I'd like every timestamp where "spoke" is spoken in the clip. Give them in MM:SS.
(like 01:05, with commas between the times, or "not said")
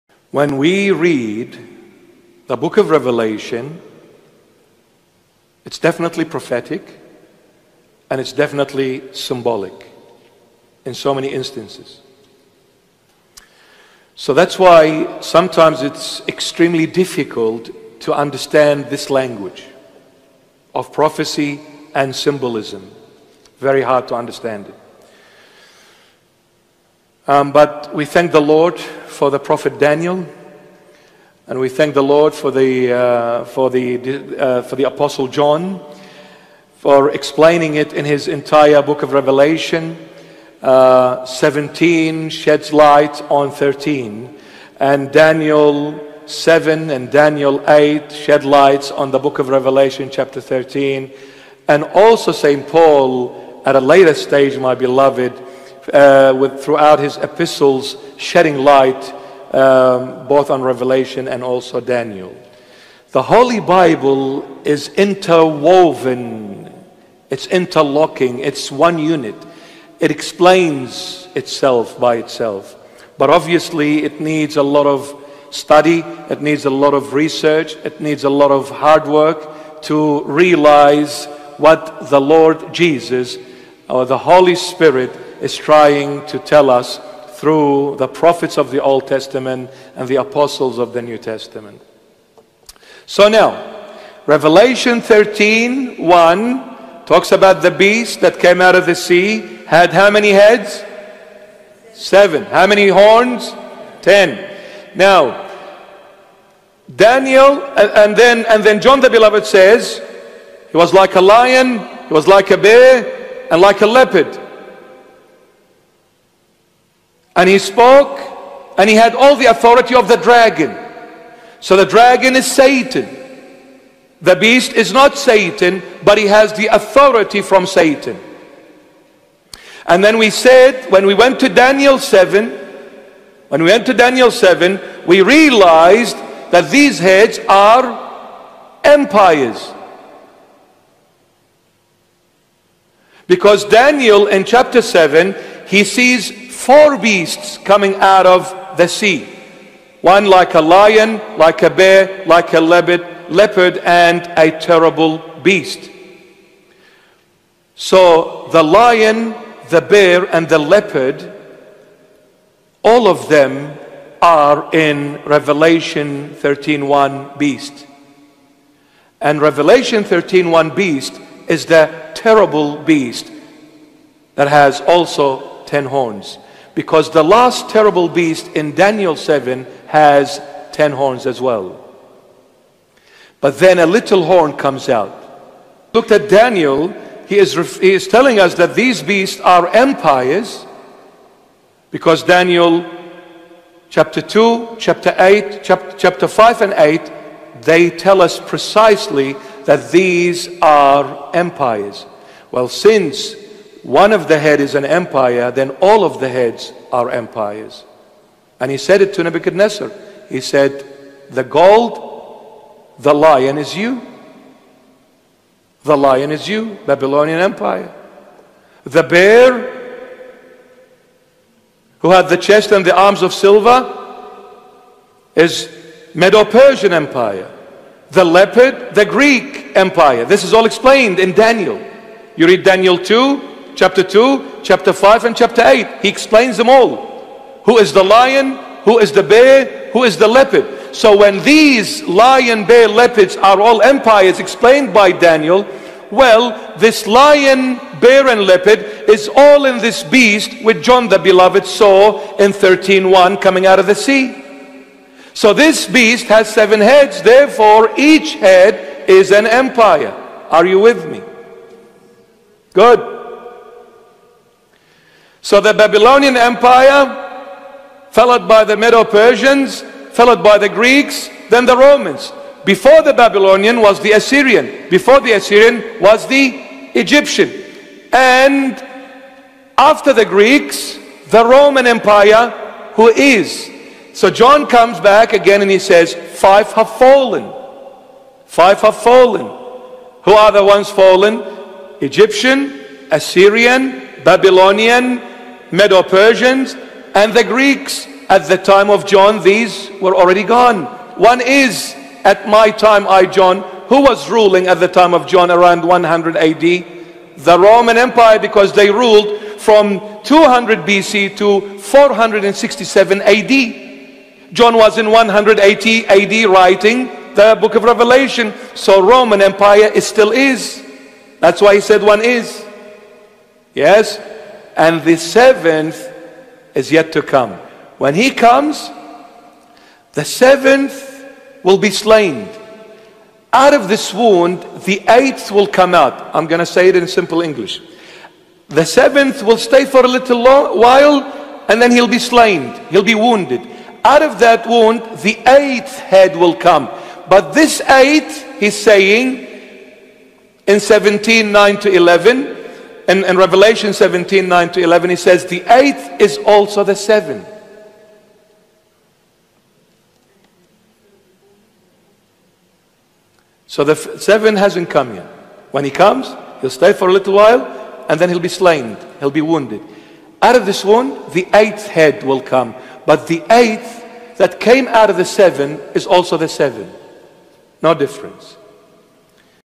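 01:57.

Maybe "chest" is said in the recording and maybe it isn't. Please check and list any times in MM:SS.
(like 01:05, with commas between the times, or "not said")
03:42.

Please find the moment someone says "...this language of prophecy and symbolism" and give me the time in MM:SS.
00:18.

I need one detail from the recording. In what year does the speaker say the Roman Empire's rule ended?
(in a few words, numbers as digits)
467 AD.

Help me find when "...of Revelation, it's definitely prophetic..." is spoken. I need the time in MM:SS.
00:02.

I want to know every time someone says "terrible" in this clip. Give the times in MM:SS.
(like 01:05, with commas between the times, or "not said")
02:34, 02:52, 02:57.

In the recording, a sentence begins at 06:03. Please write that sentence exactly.
So the f- seven hasn't come yet.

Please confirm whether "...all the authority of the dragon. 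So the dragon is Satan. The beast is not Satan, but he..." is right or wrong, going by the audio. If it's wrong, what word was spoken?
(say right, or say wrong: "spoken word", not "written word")
right.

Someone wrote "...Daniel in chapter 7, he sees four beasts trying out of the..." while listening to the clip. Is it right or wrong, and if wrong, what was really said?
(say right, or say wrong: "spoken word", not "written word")
wrong: "coming", not "trying".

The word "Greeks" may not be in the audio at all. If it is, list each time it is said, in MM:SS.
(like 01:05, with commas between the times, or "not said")
03:49, 04:30, 04:40, 04:57.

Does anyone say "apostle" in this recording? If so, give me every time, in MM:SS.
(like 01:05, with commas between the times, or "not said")
00:34, 01:30.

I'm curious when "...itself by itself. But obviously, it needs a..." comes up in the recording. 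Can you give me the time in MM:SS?
01:11.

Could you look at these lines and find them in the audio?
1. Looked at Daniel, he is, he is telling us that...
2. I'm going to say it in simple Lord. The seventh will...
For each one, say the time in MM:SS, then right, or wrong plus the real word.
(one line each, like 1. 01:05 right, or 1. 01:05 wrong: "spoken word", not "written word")
1. 03:05 right
2. 05:36 wrong: "English", not "Lord".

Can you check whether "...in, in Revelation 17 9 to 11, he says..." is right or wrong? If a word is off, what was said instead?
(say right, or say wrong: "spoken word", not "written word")
right.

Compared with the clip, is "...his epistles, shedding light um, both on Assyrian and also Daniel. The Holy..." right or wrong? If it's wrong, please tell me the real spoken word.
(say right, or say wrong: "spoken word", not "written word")
wrong: "Revelation", not "Assyrian".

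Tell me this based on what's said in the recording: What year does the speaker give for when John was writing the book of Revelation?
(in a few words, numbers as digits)
180 AD.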